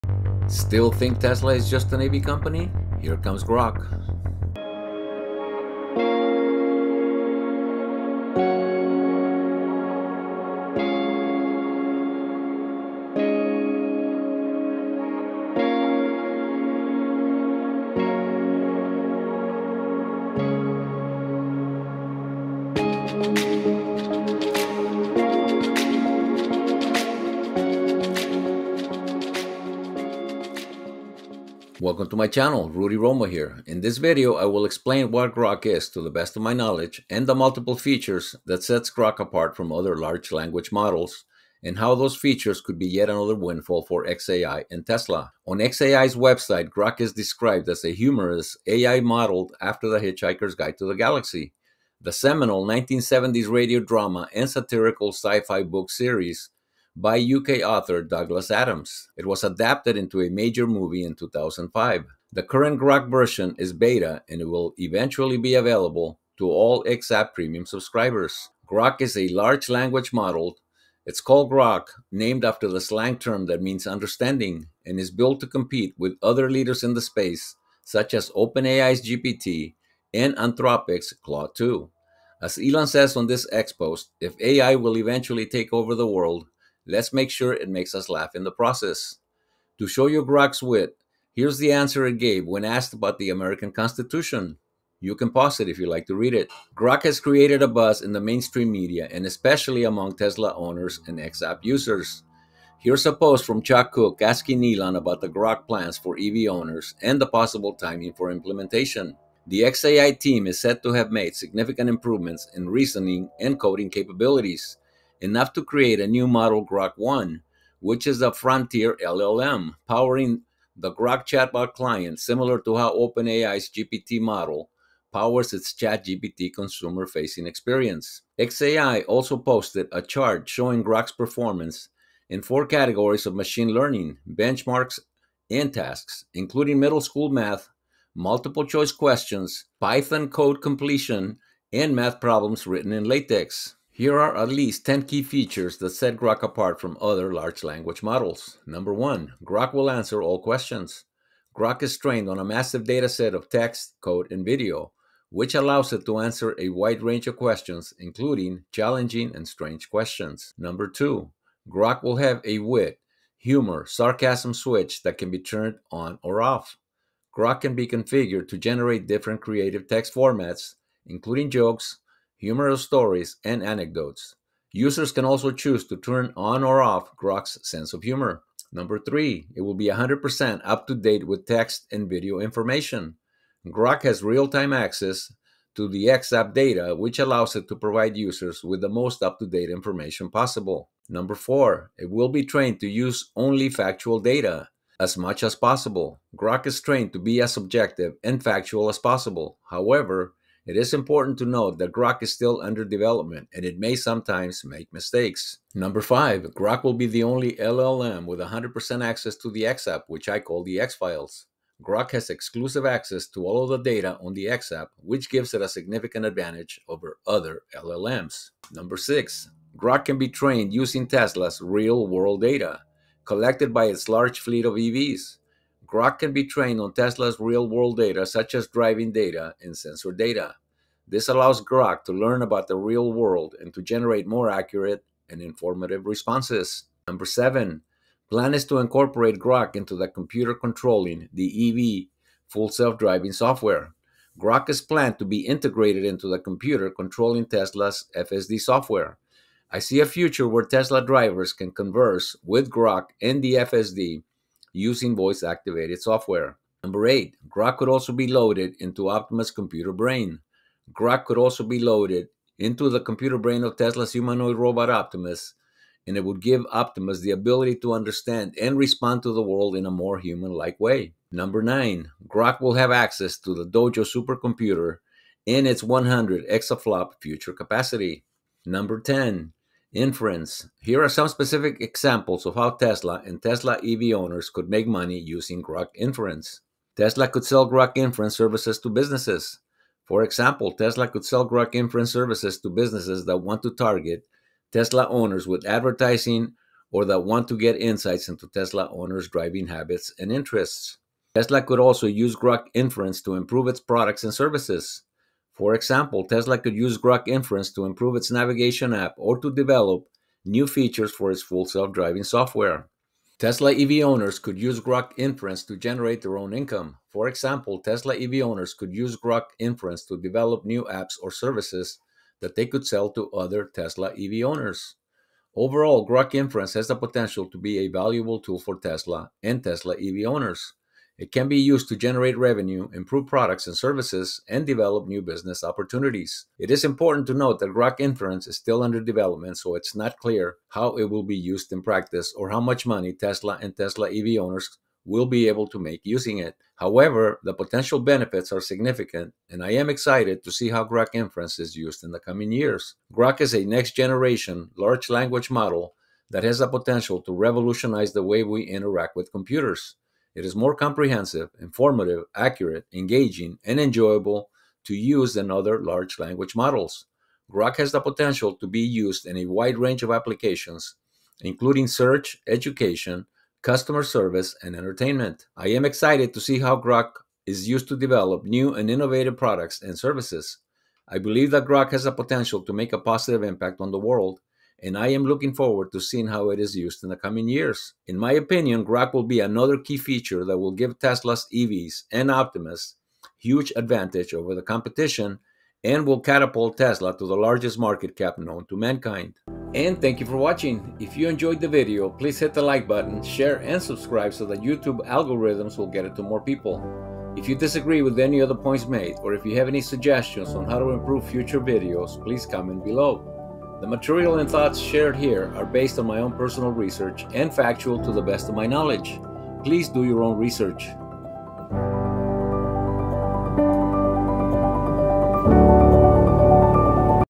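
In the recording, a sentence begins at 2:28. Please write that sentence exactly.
Number one, Grok will answer all questions.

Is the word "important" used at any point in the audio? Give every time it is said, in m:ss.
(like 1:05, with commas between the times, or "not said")
3:20, 5:36.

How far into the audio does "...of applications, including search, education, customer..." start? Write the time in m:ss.
6:10.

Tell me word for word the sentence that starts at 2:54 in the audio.
Users can also choose to turn on or off Grok's sense of humor.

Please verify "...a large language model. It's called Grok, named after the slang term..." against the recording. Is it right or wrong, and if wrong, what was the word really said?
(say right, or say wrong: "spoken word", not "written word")
right.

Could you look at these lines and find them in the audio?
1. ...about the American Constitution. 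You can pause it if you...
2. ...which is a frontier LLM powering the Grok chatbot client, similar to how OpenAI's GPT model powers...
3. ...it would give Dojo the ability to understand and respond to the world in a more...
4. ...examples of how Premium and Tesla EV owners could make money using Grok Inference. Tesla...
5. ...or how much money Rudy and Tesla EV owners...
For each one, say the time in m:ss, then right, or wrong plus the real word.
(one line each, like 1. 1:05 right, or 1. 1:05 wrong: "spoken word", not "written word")
1. 1:32 right
2. 1:57 right
3. 4:26 wrong: "Optimus", not "Dojo"
4. 4:41 wrong: "Tesla", not "Premium"
5. 5:42 wrong: "Tesla", not "Rudy".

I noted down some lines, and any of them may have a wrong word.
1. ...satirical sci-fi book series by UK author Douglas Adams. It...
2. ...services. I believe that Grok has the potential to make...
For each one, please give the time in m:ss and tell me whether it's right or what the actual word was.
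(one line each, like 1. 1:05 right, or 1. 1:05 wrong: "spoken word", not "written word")
1. 0:54 right
2. 6:19 right.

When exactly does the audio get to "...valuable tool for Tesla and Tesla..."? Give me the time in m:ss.
5:27.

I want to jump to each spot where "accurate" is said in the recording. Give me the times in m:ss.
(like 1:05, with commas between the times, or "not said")
3:54, 6:02.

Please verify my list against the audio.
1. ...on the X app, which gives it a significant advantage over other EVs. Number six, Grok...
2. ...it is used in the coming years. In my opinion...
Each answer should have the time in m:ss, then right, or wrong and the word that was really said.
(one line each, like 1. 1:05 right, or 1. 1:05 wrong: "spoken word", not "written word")
1. 3:34 wrong: "LLMs", not "EVs"
2. 6:26 right.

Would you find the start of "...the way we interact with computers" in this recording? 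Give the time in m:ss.
5:58.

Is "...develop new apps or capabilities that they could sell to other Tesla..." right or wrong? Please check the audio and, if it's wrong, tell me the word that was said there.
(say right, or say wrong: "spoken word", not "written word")
wrong: "services", not "capabilities".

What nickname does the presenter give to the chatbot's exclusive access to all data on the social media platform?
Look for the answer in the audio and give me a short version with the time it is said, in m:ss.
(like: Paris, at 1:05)
The X Files, at 3:30.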